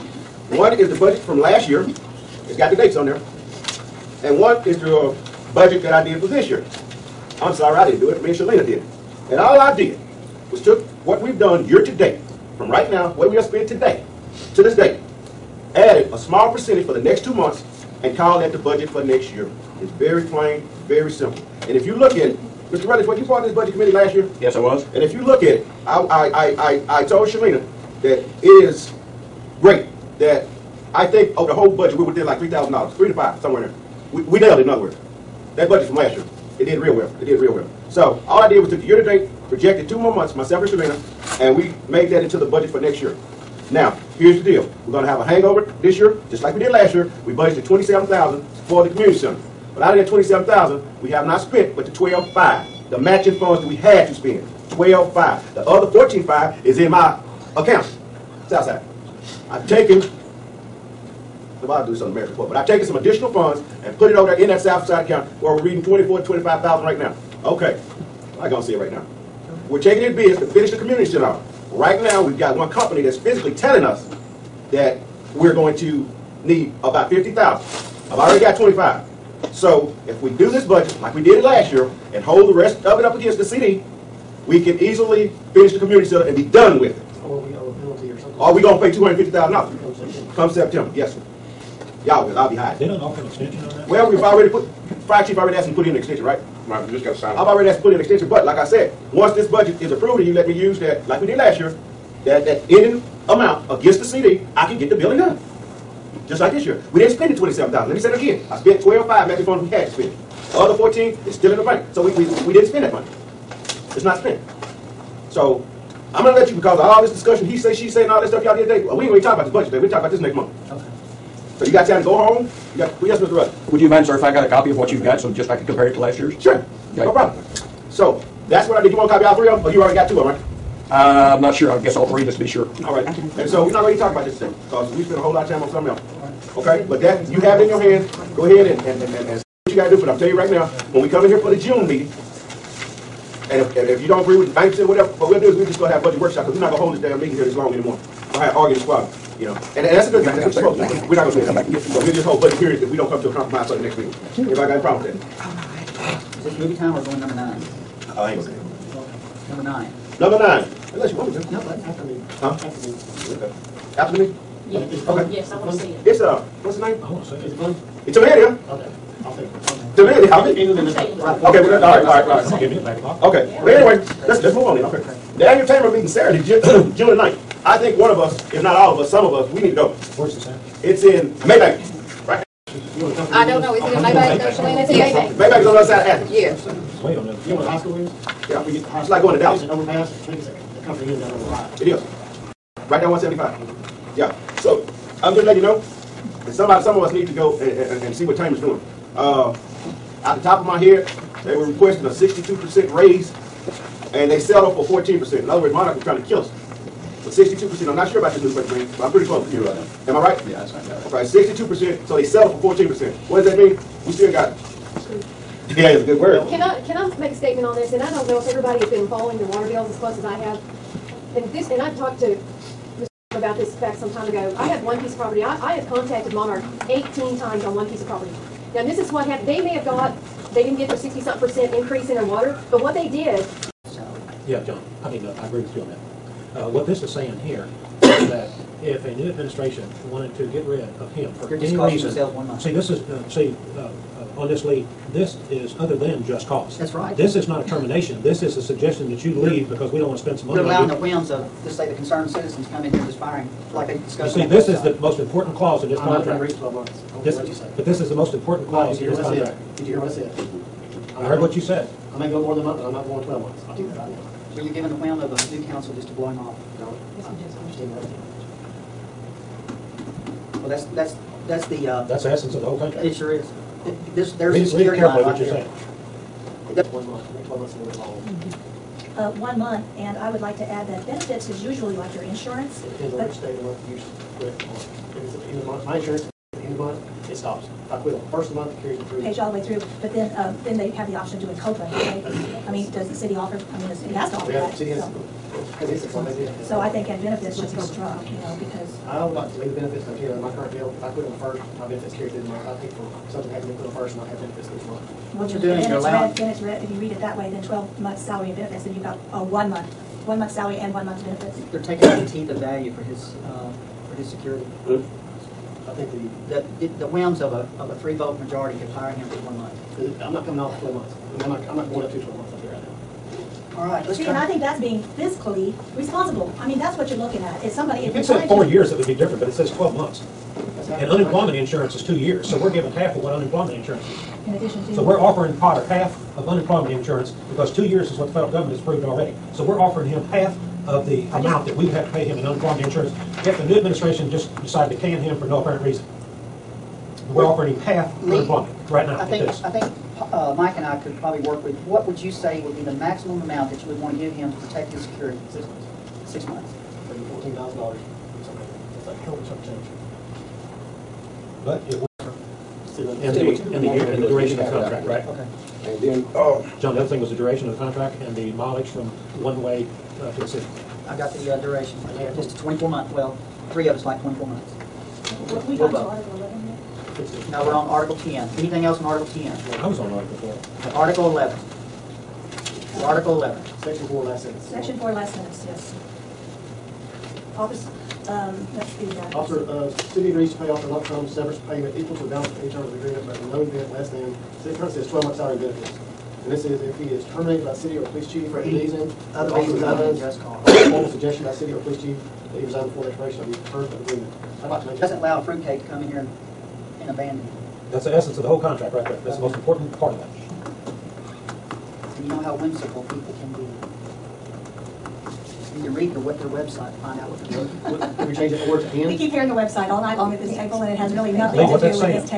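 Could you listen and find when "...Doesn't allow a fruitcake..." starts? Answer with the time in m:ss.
6:45.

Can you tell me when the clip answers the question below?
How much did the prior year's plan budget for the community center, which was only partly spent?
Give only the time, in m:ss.
0:47.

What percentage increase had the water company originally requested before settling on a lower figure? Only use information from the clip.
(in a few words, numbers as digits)
62%.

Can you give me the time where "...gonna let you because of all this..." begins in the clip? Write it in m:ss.
1:56.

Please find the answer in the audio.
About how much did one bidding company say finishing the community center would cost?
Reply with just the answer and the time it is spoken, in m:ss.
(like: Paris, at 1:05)
50,000, at 1:15.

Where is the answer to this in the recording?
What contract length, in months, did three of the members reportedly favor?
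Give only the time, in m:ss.
6:13.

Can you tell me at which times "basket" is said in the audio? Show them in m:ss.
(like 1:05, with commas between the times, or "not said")
not said.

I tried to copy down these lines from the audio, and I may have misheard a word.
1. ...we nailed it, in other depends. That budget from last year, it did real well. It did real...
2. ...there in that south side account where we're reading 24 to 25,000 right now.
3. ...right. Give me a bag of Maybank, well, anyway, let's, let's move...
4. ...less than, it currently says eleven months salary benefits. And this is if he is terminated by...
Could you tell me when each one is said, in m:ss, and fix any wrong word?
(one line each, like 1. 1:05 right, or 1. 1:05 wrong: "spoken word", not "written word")
1. 0:34 wrong: "words", not "depends"
2. 1:04 right
3. 2:52 wrong: "Okay", not "Maybank"
4. 6:33 wrong: "twelve", not "eleven".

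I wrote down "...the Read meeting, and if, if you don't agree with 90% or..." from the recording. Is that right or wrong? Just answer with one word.
wrong.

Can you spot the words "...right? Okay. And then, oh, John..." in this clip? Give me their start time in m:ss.
6:05.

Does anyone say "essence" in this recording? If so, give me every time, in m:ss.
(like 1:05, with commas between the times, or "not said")
4:32, 6:48.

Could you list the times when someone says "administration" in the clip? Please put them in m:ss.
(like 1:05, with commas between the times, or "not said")
3:59, 5:43.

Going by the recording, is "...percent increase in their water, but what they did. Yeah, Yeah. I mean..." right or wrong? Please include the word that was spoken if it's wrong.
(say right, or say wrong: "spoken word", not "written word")
wrong: "John", not "Yeah".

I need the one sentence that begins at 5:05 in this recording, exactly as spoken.
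well, you're then doing then you're it's red.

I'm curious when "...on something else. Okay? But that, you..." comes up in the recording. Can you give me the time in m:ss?
2:15.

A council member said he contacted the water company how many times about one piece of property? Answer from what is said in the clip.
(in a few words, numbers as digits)
18.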